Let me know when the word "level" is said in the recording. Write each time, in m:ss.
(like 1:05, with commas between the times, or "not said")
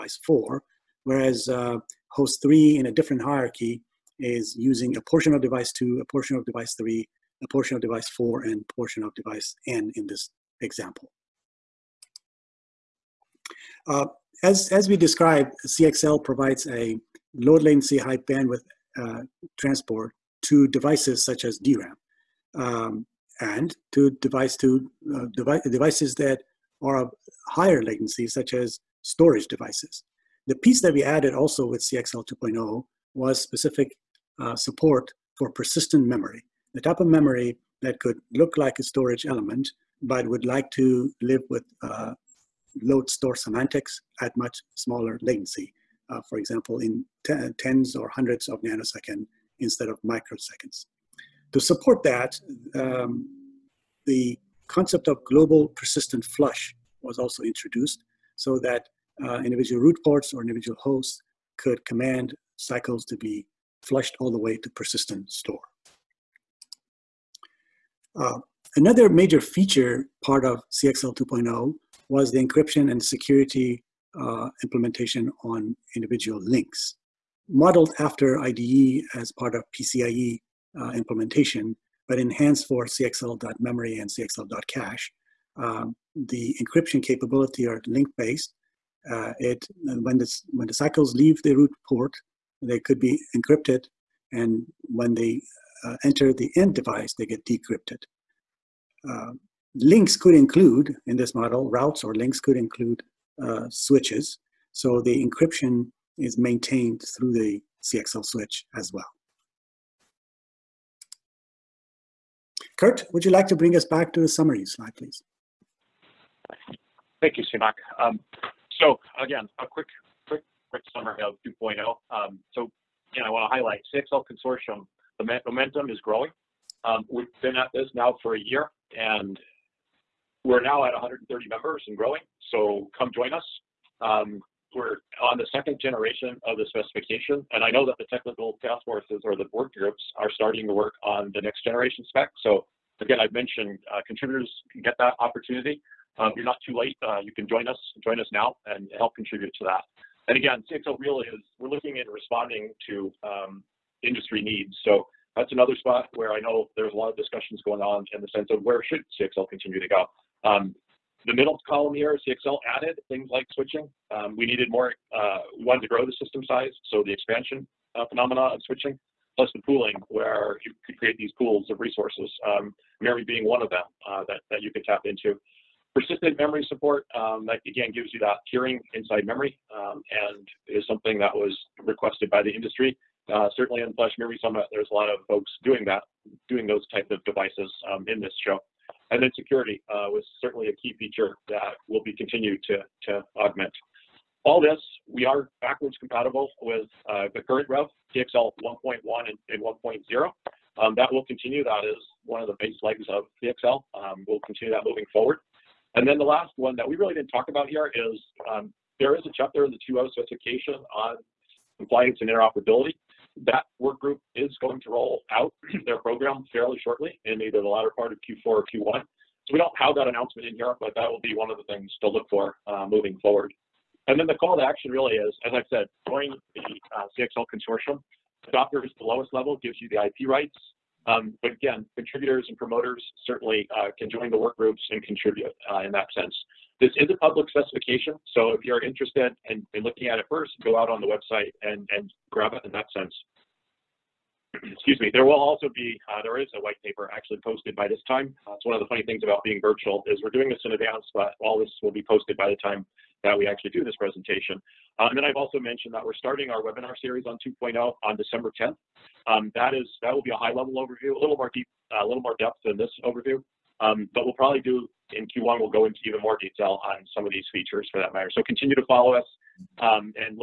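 3:49, 4:20.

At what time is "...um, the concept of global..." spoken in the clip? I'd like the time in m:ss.
0:52.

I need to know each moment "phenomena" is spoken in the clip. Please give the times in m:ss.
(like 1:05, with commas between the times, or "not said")
2:48.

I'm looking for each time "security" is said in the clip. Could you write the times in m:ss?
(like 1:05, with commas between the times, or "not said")
1:13, 3:09.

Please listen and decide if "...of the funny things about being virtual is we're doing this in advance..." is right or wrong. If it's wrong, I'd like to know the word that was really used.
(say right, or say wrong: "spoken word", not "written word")
right.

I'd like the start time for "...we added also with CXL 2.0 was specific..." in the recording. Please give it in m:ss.
0:30.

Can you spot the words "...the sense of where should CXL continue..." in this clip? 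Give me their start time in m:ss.
2:38.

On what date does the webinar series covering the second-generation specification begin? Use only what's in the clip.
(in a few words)
December 10th.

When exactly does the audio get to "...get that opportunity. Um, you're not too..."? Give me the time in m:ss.
2:24.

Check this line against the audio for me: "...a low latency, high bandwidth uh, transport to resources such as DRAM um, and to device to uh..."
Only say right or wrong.
wrong.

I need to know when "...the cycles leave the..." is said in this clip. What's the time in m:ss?
1:30.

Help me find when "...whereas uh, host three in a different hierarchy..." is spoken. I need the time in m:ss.
0:01.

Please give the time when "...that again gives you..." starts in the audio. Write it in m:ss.
2:57.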